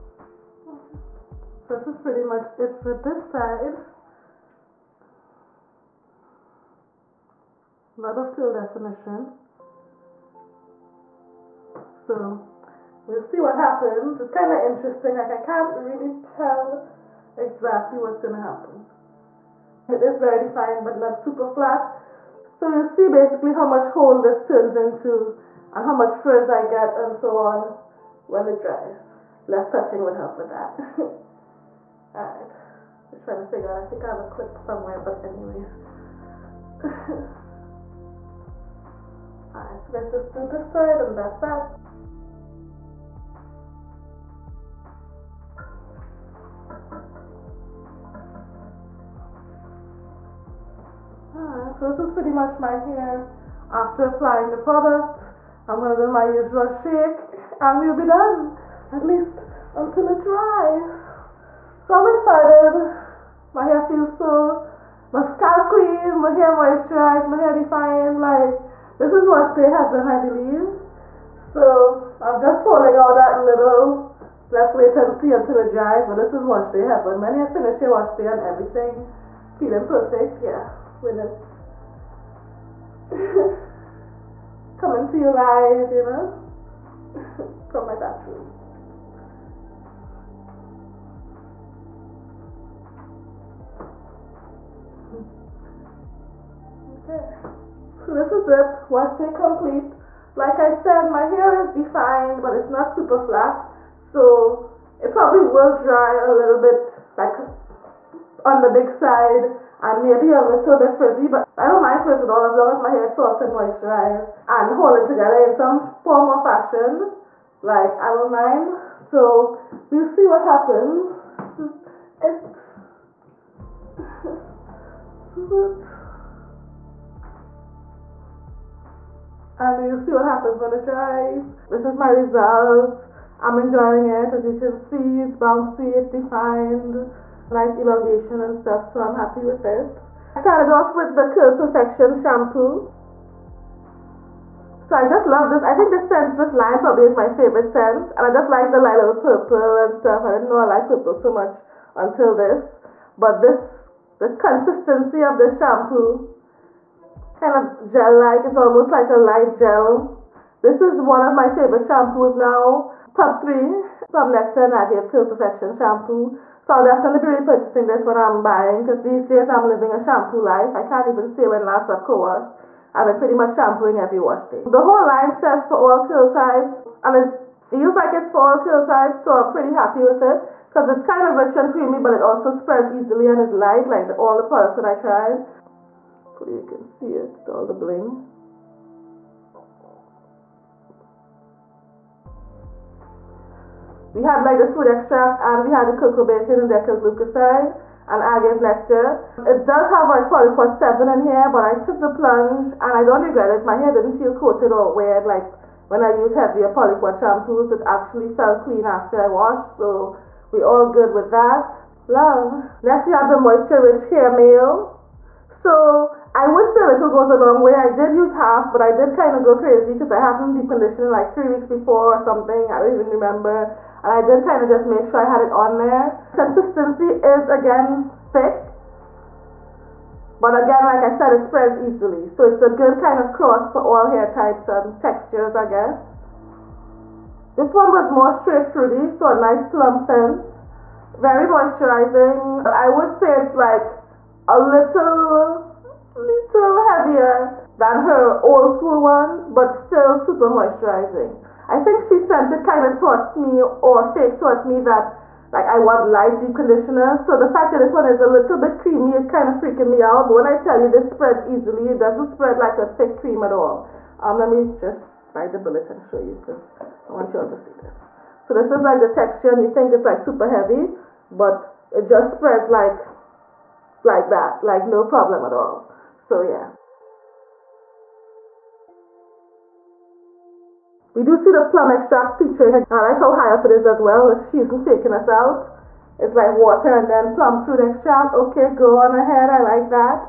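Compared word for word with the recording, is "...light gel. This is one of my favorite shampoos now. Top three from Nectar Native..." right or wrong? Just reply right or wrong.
right.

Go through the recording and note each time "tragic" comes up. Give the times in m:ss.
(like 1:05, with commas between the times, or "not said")
not said.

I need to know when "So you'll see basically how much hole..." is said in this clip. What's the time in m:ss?
0:22.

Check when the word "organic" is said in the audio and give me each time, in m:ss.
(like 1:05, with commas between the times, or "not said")
not said.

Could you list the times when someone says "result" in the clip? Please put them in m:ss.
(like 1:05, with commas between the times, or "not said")
2:12.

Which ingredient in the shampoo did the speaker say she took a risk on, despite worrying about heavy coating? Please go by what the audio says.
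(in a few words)
polyquat 7.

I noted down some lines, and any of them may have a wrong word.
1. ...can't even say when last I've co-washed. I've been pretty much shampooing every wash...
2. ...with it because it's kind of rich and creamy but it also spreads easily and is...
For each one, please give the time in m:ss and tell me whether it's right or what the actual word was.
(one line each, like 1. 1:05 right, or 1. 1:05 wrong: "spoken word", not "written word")
1. 2:50 right
2. 3:00 right.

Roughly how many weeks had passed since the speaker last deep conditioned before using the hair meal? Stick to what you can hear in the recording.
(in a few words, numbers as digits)
3.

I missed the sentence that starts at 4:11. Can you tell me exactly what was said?
I think She Scent It kind of taught me, or fake taught me that like I want light deep conditioners.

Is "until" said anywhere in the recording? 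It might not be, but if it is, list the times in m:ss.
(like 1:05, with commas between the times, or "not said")
0:59, 1:15, 2:31.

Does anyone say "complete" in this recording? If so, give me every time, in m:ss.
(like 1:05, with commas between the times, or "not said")
1:39.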